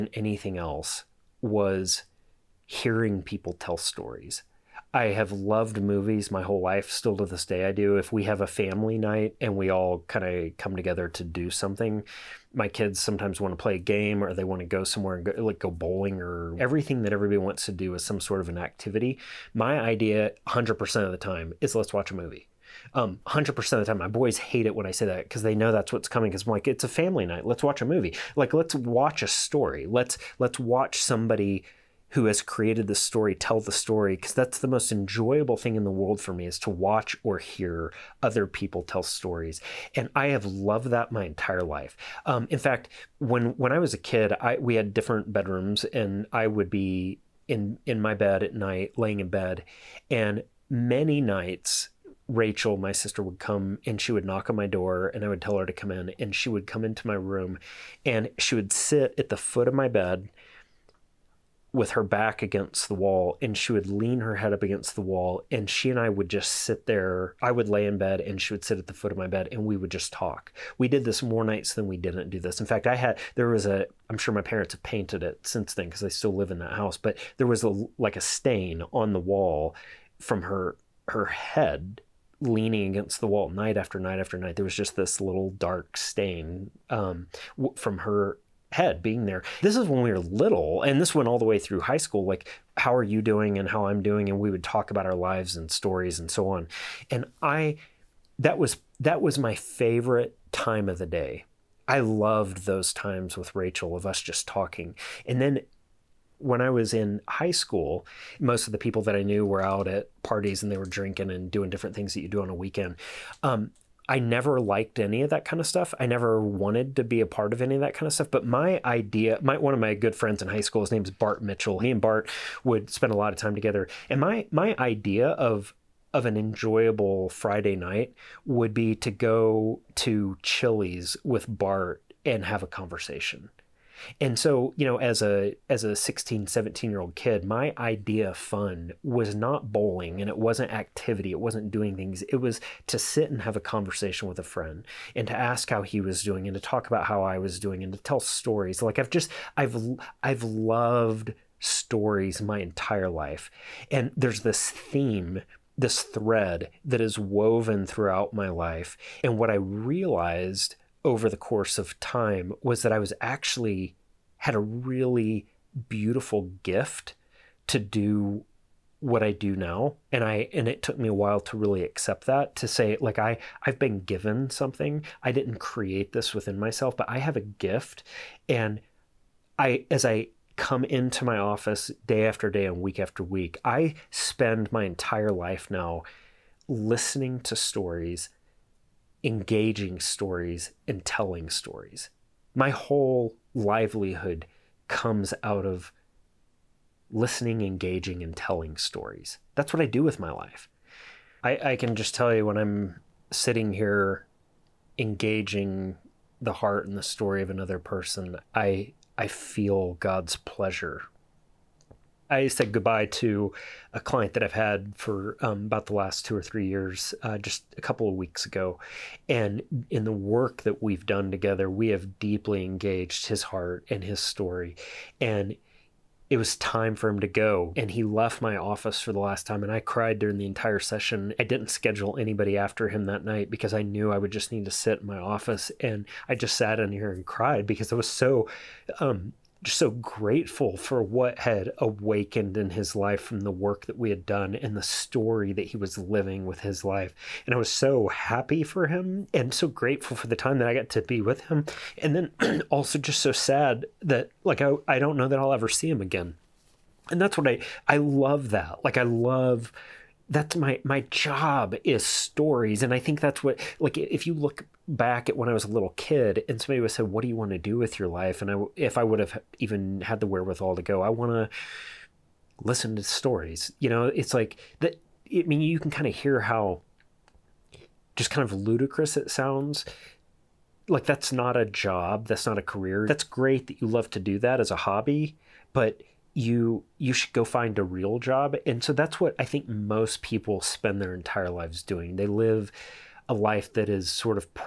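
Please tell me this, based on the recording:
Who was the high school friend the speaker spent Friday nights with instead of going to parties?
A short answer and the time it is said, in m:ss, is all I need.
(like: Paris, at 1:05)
Bart Mitchell, at 2:01.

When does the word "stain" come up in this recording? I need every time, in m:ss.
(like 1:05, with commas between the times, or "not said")
1:18, 1:25.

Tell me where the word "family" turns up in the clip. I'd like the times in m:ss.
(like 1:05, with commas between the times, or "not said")
0:08, 0:26.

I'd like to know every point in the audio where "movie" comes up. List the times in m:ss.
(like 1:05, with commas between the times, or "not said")
0:05, 0:22, 0:27.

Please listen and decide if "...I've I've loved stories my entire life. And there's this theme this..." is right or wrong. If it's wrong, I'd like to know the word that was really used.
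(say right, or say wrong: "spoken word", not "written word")
right.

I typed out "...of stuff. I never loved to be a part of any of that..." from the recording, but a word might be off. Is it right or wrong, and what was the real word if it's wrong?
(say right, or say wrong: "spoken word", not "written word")
wrong: "wanted", not "loved".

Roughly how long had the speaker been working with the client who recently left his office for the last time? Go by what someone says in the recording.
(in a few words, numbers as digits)
2 or 3 years.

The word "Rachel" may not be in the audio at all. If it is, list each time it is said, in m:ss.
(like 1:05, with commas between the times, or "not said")
0:52, 1:43.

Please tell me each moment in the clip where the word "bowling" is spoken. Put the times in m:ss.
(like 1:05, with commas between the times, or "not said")
0:15, 2:19.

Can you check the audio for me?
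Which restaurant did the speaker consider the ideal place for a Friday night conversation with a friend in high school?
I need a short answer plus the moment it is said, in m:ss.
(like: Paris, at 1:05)
Chili's, at 2:10.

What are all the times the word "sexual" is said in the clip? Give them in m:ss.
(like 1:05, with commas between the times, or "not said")
not said.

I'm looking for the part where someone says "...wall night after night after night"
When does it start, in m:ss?
1:23.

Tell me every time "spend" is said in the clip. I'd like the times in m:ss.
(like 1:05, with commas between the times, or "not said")
2:02, 3:04, 4:50.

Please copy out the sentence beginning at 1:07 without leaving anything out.
I would lay in bed and she would sit at the foot of my bed and we would just talk.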